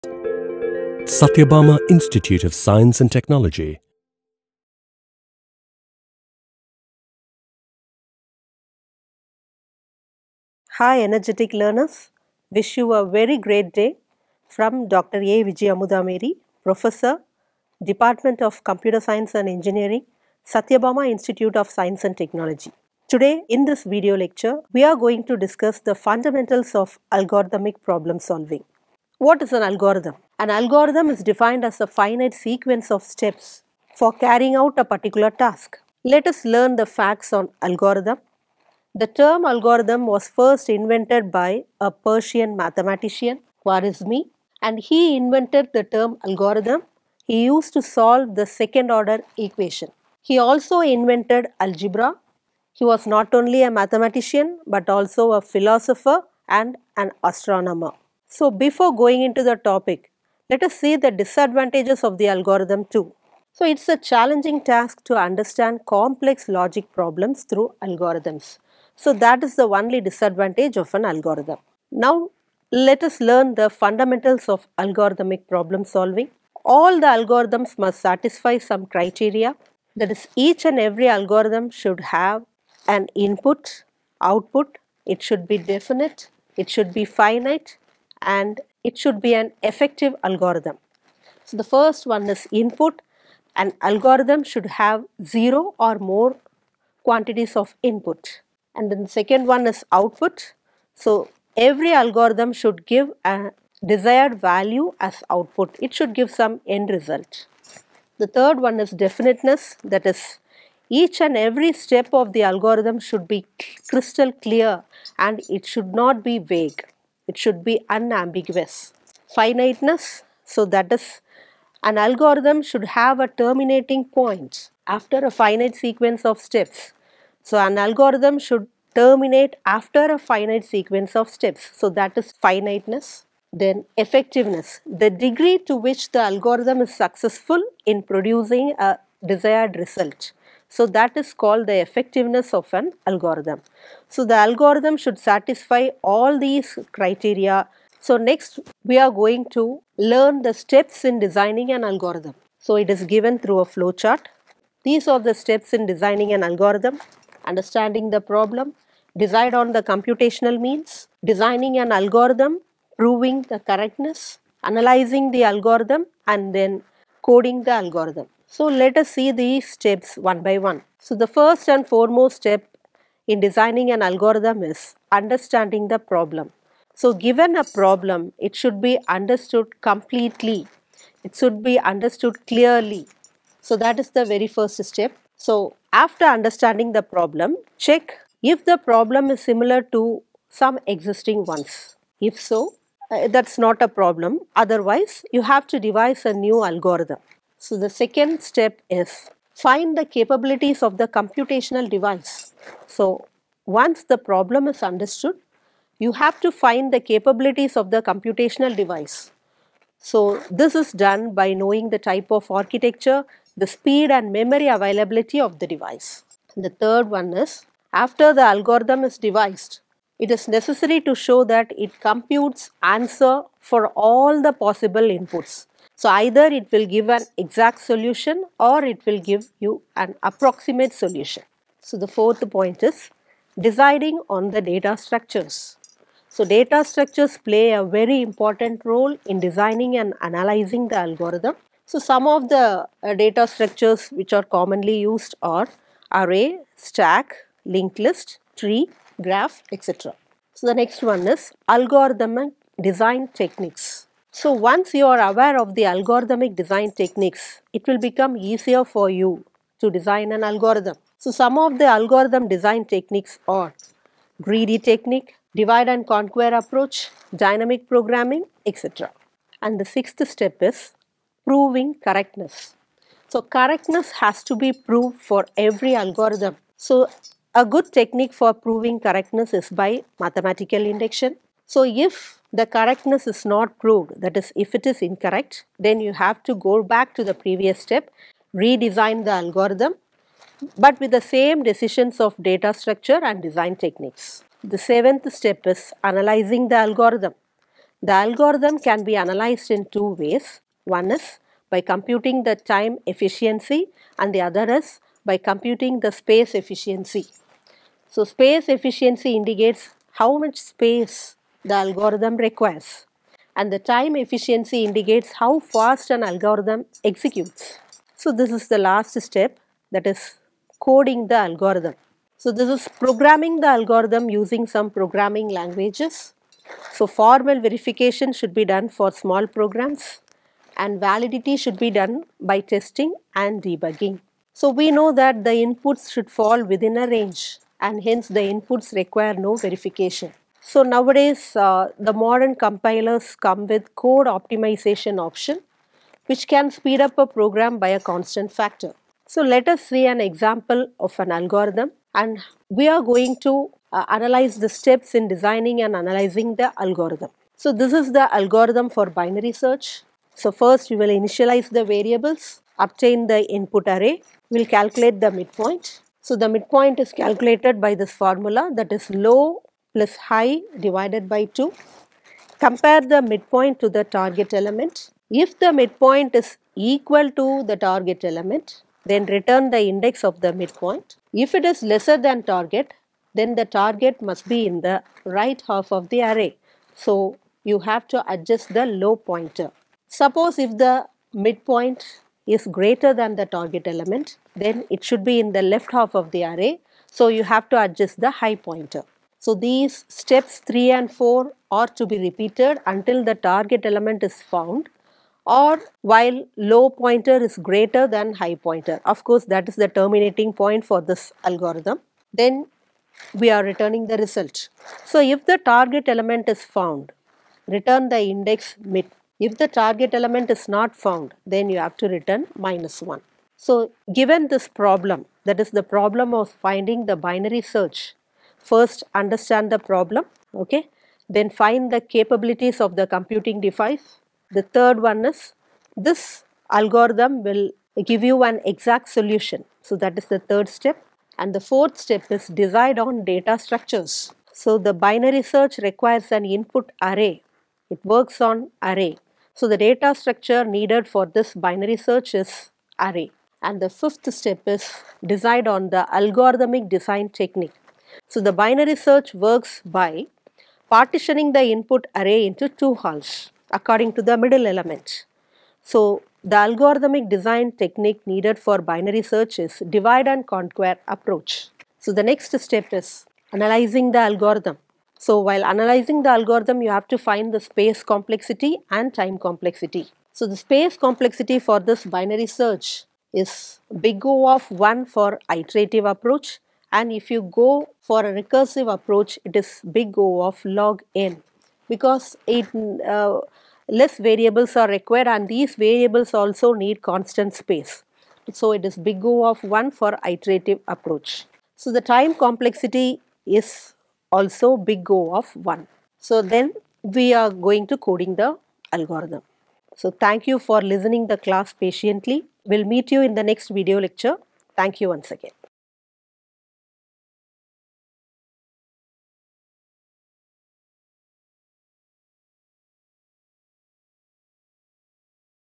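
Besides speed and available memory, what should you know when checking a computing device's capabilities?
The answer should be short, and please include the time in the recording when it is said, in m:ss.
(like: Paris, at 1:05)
Type of architecture, at 3:31.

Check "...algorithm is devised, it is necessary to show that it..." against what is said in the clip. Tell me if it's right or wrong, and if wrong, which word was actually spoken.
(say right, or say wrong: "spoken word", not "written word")
right.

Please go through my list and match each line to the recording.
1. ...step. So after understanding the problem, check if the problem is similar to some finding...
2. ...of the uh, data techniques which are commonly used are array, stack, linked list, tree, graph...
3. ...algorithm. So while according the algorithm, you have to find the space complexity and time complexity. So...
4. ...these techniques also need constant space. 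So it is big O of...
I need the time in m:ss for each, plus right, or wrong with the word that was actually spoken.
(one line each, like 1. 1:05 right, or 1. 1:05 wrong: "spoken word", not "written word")
1. 3:04 wrong: "existing", not "finding"
2. 4:02 wrong: "structures", not "techniques"
3. 7:54 wrong: "analyzing", not "according"
4. 8:15 wrong: "variables", not "techniques".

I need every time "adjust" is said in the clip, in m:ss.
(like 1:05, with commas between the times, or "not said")
6:28, 6:37.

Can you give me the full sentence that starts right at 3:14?
Otherwise, you have to devise a new algorithm.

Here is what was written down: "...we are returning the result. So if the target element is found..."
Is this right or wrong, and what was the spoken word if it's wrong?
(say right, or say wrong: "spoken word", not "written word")
right.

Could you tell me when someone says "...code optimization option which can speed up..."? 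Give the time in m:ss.
5:43.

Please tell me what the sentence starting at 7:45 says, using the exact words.
So the algorithmic design technique needed for binary search is divide and conquer approach.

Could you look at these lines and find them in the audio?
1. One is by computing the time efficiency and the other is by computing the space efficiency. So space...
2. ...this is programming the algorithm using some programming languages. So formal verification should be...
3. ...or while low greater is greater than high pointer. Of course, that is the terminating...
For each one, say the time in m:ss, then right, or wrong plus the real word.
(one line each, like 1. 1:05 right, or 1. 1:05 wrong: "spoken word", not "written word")
1. 5:00 right
2. 5:22 right
3. 6:45 wrong: "pointer", not "greater".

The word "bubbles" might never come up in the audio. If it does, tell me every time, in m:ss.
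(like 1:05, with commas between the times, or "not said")
not said.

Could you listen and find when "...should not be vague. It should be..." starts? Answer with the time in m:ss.
1:55.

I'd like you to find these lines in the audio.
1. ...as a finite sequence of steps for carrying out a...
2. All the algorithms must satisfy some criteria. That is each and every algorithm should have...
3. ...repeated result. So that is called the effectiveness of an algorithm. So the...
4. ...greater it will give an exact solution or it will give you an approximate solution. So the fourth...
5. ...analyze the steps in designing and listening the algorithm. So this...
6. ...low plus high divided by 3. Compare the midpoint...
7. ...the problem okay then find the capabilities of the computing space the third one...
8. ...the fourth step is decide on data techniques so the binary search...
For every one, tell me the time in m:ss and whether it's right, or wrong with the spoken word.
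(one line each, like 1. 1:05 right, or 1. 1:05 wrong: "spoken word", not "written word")
1. 0:31 right
2. 1:16 right
3. 2:19 wrong: "desired", not "repeated"
4. 3:46 wrong: "either", not "greater"
5. 5:54 wrong: "analyzing", not "listening"
6. 6:09 wrong: "2", not "3"
7. 7:09 wrong: "device", not "space"
8. 7:21 wrong: "structures", not "techniques".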